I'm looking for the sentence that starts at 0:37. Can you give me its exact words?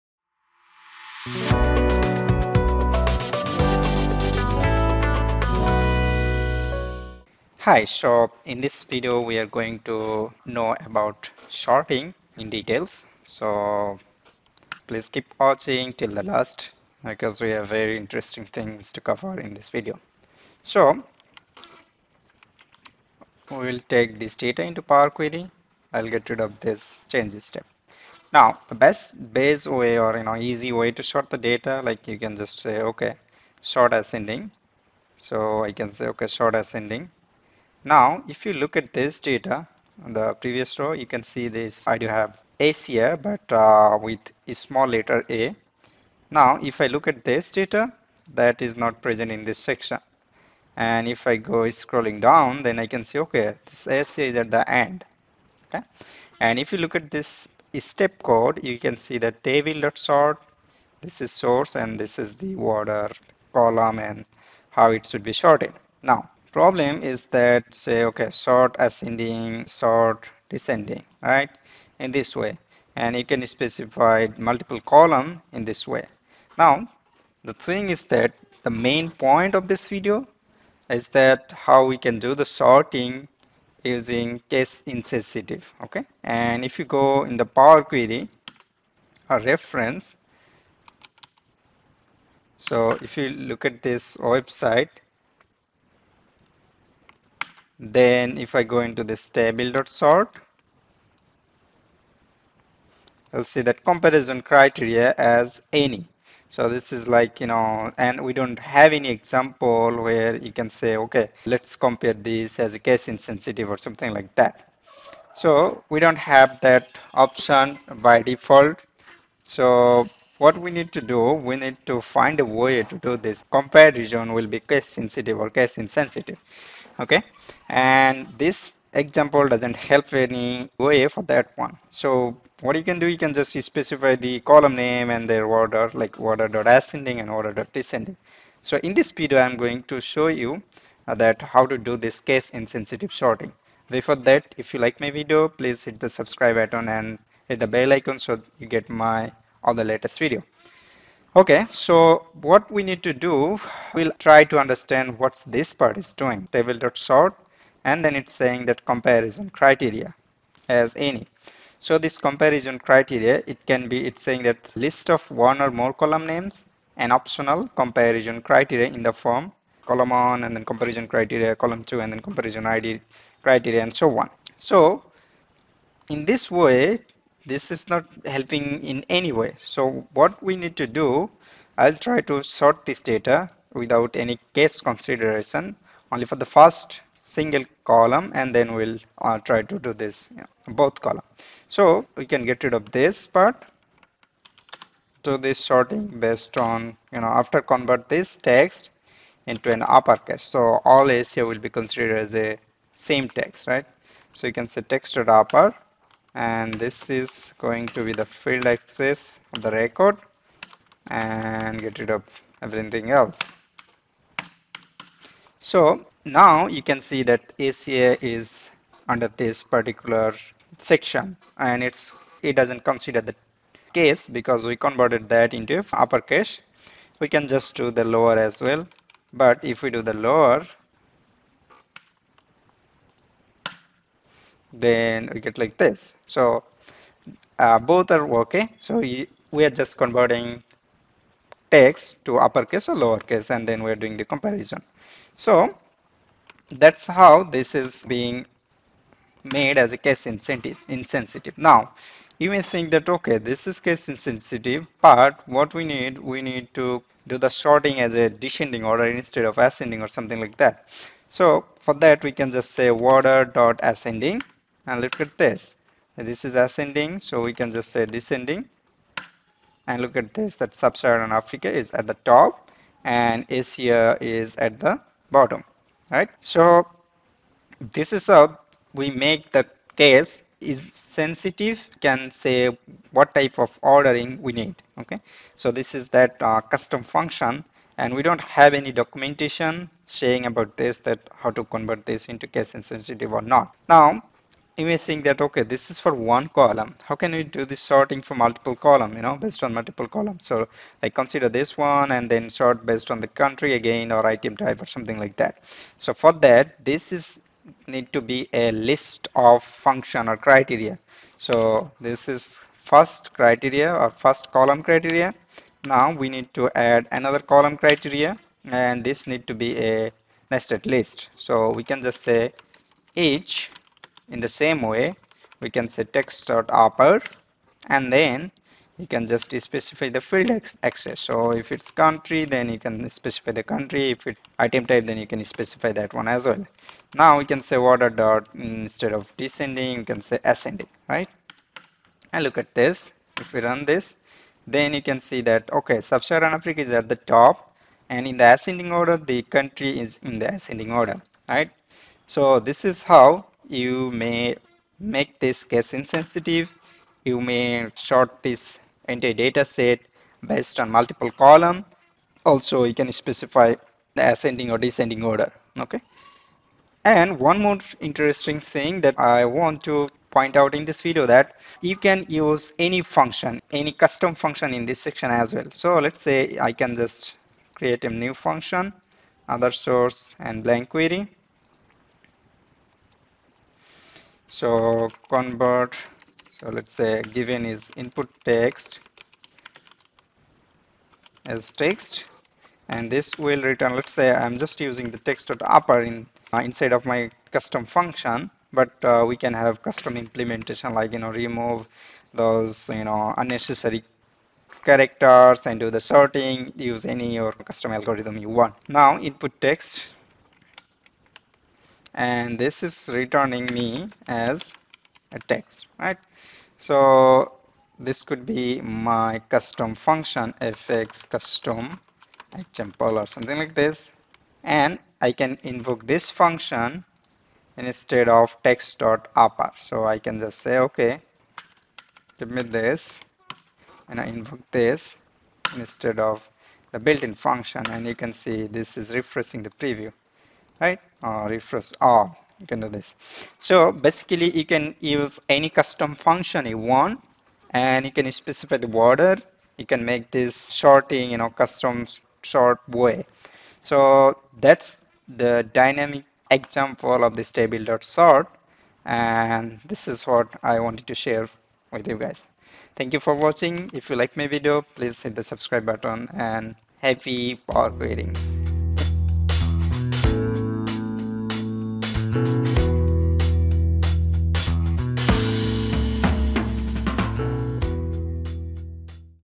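Now, if you look at this data the previous row, you can see this.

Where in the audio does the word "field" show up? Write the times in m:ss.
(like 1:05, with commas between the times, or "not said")
3:28, 5:30.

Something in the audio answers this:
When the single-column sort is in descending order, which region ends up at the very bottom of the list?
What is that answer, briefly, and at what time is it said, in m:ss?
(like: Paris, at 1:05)
Asia, at 4:33.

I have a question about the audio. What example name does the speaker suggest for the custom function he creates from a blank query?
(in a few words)
fx custom example.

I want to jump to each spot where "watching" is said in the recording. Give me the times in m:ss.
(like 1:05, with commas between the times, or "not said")
0:15, 7:43.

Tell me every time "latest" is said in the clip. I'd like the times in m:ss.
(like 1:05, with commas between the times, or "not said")
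2:29.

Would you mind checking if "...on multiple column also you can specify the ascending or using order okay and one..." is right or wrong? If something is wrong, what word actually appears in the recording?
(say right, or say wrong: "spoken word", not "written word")
wrong: "descending", not "using".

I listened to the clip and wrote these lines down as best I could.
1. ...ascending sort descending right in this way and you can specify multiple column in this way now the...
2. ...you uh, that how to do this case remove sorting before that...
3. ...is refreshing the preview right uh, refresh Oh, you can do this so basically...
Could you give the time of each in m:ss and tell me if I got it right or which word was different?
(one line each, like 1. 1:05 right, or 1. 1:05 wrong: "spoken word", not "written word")
1. 1:08 right
2. 2:20 wrong: "insensitive", not "remove"
3. 7:18 right.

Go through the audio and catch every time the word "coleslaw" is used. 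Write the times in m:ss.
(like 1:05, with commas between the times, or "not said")
not said.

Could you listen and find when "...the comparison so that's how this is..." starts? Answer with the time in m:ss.
4:04.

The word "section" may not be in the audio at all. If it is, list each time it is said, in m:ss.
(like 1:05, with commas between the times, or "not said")
0:49, 3:40, 6:14.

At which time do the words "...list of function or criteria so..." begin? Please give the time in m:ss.
5:08.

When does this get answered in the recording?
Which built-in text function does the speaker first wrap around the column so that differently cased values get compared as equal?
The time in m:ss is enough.
3:24.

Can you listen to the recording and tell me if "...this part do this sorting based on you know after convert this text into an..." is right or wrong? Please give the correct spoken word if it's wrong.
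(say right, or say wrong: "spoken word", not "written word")
right.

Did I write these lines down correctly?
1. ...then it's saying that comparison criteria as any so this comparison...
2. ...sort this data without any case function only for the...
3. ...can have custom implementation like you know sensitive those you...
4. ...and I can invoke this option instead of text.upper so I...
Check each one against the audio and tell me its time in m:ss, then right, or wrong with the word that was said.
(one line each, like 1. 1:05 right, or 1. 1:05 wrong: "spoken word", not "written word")
1. 2:38 right
2. 3:02 wrong: "consideration", not "function"
3. 6:39 wrong: "remove", not "sensitive"
4. 7:04 wrong: "function", not "option".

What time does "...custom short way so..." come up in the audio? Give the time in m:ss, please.
7:31.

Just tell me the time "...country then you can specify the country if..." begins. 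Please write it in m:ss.
5:32.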